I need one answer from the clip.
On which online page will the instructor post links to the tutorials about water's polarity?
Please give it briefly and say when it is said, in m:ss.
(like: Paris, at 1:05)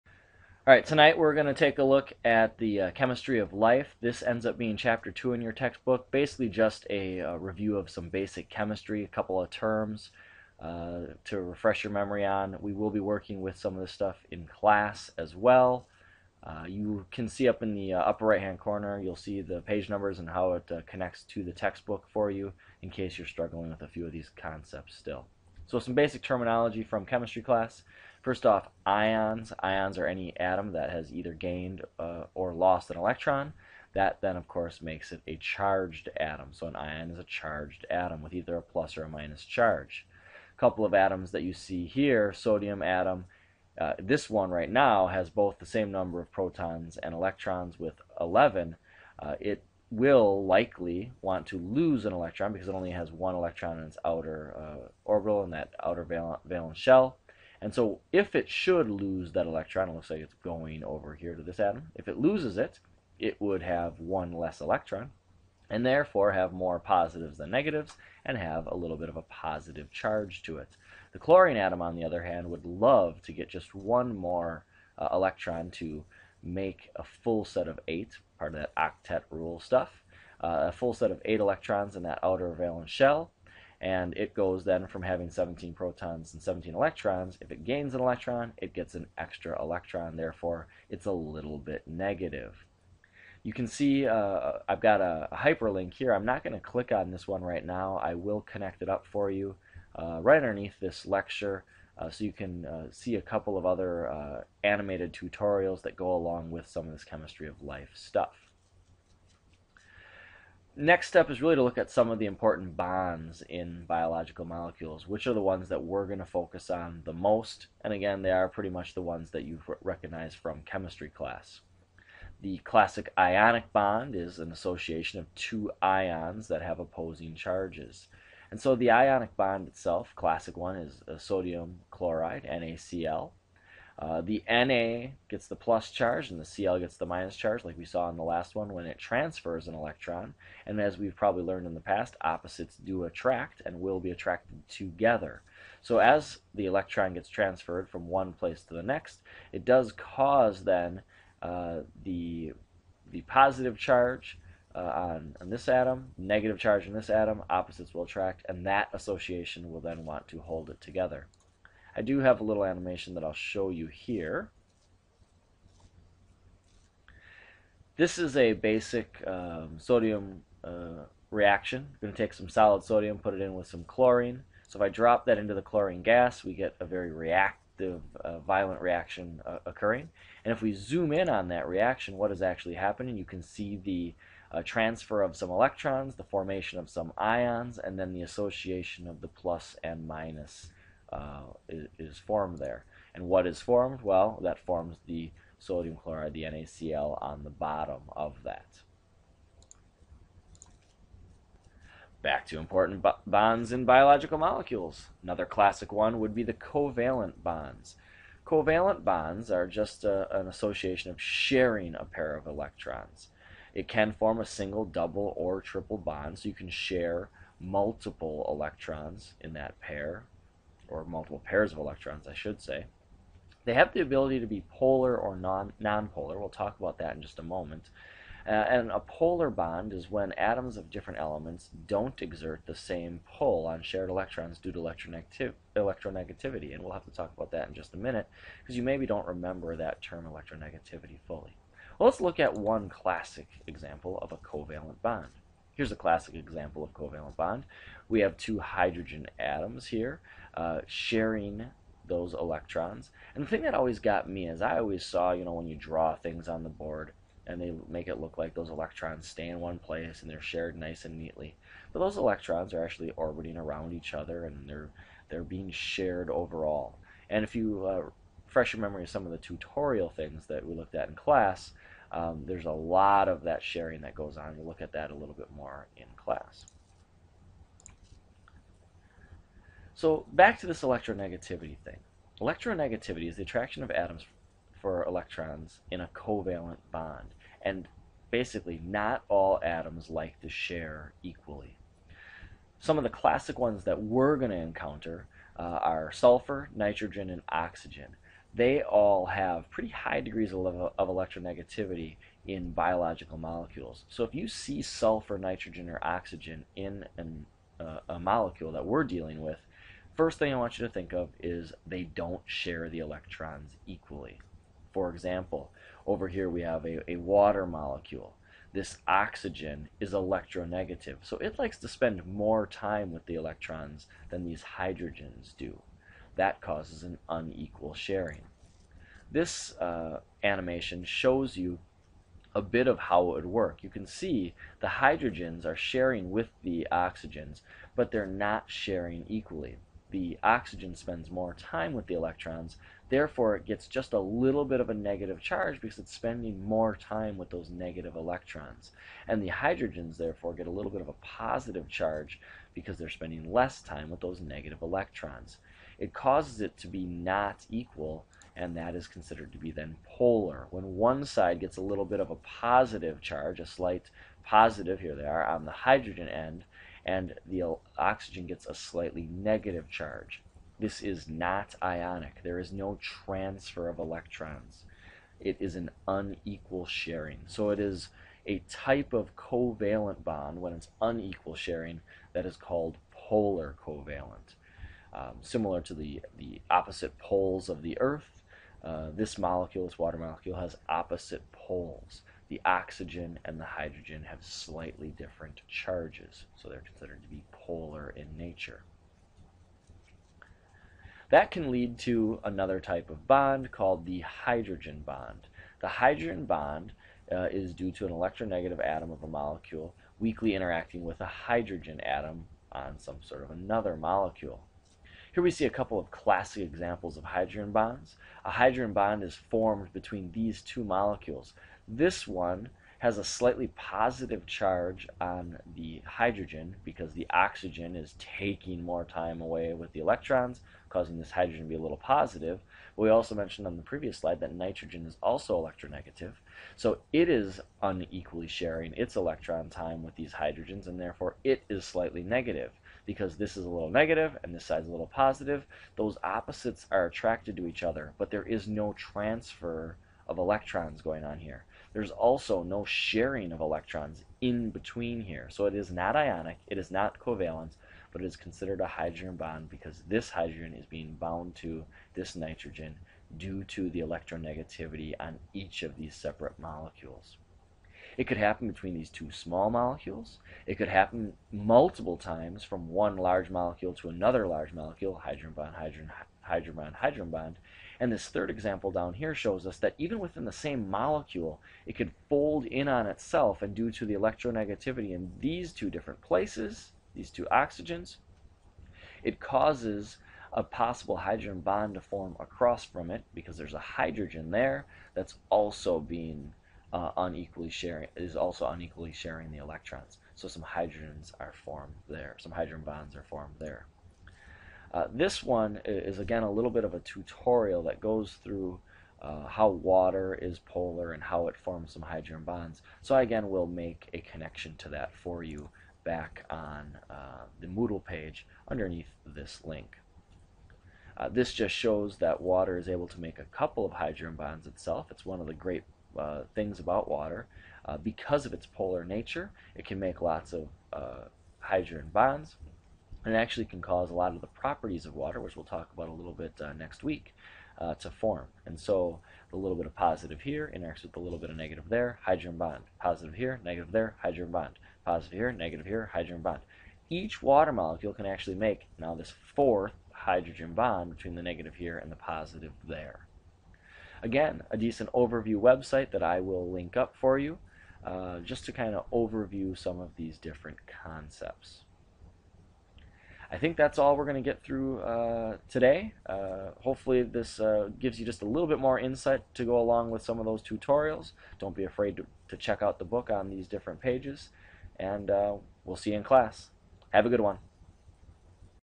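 Moodle, at 8:37.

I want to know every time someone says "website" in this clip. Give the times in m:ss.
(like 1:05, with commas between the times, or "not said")
9:15.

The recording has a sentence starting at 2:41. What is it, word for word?
I do have a little animation that I'll show you here.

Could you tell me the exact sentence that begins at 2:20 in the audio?
And as we've probably learned in the past, opposites do attract and will be attracted together.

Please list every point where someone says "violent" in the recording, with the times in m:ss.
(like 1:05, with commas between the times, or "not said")
2:58.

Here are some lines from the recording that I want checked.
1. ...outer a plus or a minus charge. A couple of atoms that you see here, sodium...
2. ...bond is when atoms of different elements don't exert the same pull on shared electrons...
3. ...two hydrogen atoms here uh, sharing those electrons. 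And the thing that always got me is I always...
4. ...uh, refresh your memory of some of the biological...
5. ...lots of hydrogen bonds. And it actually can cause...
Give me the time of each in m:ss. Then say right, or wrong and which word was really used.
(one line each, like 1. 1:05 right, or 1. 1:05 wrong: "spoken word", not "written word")
1. 0:38 wrong: "either", not "outer"
2. 3:49 right
3. 4:08 right
4. 4:27 wrong: "tutorial", not "biological"
5. 8:50 right.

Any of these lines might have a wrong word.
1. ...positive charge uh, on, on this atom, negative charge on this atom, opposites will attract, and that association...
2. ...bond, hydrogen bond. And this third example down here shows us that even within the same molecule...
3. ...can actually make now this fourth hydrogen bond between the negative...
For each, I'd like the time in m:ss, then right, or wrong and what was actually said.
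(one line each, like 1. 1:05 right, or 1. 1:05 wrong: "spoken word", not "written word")
1. 2:33 right
2. 7:56 right
3. 9:08 right.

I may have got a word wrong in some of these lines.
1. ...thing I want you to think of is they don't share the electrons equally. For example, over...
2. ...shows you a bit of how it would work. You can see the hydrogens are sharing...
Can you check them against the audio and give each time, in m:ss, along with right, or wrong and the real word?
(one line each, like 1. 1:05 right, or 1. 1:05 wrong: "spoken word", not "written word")
1. 5:10 right
2. 5:31 right.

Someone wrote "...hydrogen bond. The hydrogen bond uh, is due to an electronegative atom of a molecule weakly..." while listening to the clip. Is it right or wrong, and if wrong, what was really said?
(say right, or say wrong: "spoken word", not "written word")
right.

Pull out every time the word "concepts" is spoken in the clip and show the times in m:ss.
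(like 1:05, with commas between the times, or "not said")
0:24, 9:21.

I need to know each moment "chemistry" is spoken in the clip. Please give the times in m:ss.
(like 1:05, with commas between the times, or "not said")
0:02, 0:08, 0:27, 1:47, 2:00.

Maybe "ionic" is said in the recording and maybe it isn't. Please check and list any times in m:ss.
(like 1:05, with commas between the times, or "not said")
2:03, 2:08, 6:11, 7:36.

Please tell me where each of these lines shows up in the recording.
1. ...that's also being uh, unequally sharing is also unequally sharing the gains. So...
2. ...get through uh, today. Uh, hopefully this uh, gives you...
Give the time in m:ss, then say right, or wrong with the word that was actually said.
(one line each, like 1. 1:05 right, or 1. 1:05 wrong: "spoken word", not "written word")
1. 8:15 wrong: "electrons", not "gains"
2. 9:24 right.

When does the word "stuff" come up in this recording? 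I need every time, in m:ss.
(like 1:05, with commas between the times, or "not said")
0:13, 1:19, 1:47.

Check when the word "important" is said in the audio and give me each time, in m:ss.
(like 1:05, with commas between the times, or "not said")
1:52, 3:22.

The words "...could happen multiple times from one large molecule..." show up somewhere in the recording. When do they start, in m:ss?
7:50.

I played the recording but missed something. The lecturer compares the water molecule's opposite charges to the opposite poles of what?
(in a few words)
the Earth.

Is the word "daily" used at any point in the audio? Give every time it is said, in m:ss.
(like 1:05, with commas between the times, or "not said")
not said.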